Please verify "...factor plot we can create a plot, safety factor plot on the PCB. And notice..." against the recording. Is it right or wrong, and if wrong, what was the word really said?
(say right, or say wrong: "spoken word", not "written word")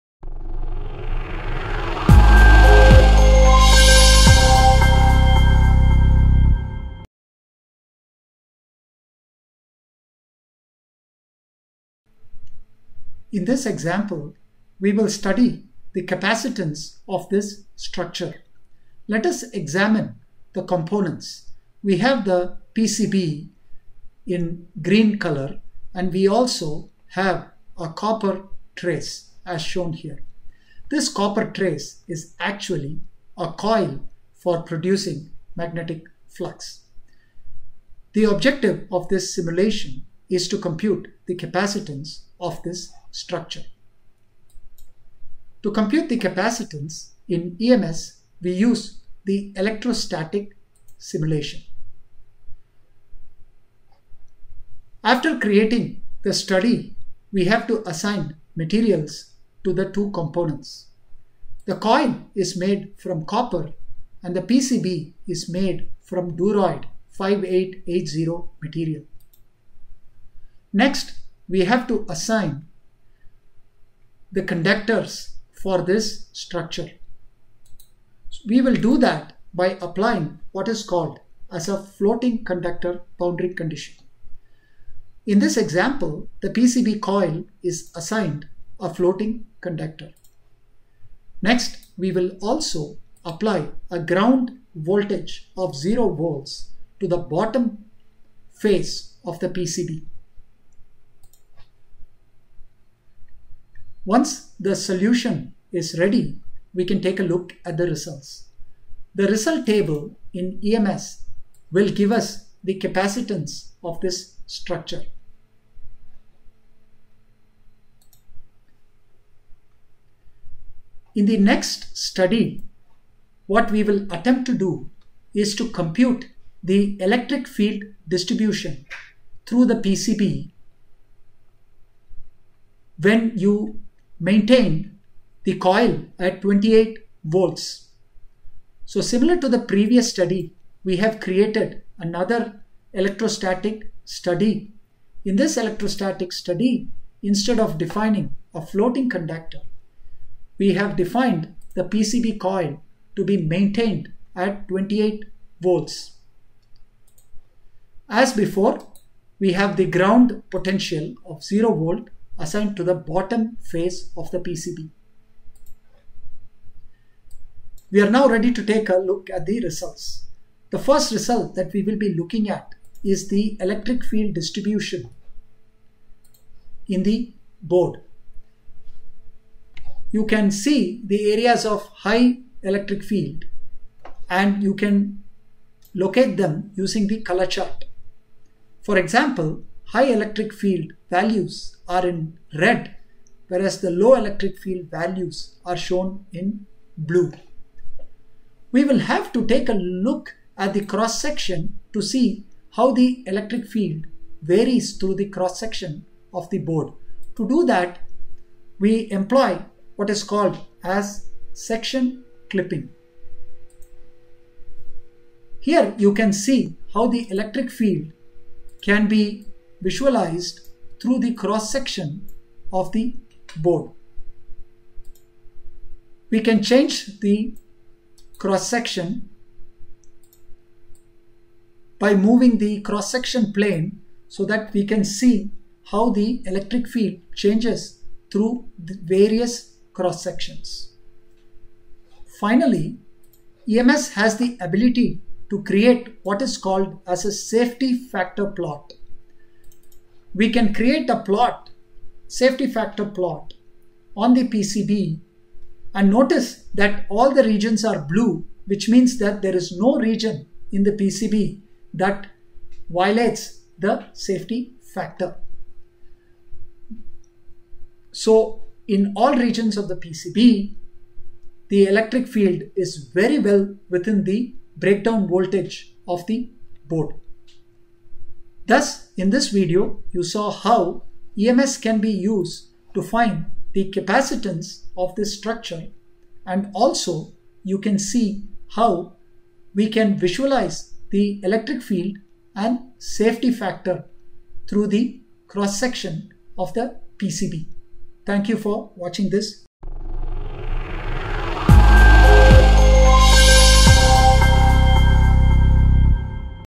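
right.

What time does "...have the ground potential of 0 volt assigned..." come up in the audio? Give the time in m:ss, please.
2:39.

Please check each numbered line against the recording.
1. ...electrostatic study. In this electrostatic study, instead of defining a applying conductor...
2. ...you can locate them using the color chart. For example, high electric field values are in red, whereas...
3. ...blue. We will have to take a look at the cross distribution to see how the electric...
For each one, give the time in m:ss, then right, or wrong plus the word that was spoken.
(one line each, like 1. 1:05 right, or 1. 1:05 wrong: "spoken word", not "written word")
1. 2:22 wrong: "floating", not "applying"
2. 3:04 right
3. 3:16 wrong: "section", not "distribution".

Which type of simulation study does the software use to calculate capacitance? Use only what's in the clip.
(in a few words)
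electrostatic simulation.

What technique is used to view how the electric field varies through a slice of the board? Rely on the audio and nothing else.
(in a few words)
section clipping.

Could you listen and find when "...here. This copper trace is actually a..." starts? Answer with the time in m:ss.
0:29.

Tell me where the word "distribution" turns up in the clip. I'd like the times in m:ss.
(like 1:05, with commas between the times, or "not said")
2:08, 2:54.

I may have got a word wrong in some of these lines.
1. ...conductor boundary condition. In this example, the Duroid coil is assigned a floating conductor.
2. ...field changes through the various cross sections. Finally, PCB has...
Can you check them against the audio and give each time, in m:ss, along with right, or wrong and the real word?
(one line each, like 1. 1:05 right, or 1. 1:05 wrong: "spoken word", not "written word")
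1. 1:22 wrong: "PCB", not "Duroid"
2. 3:56 wrong: "EMS", not "PCB".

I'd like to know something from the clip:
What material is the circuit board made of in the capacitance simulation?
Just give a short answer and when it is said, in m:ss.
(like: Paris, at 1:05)
Duroid 5880, at 1:06.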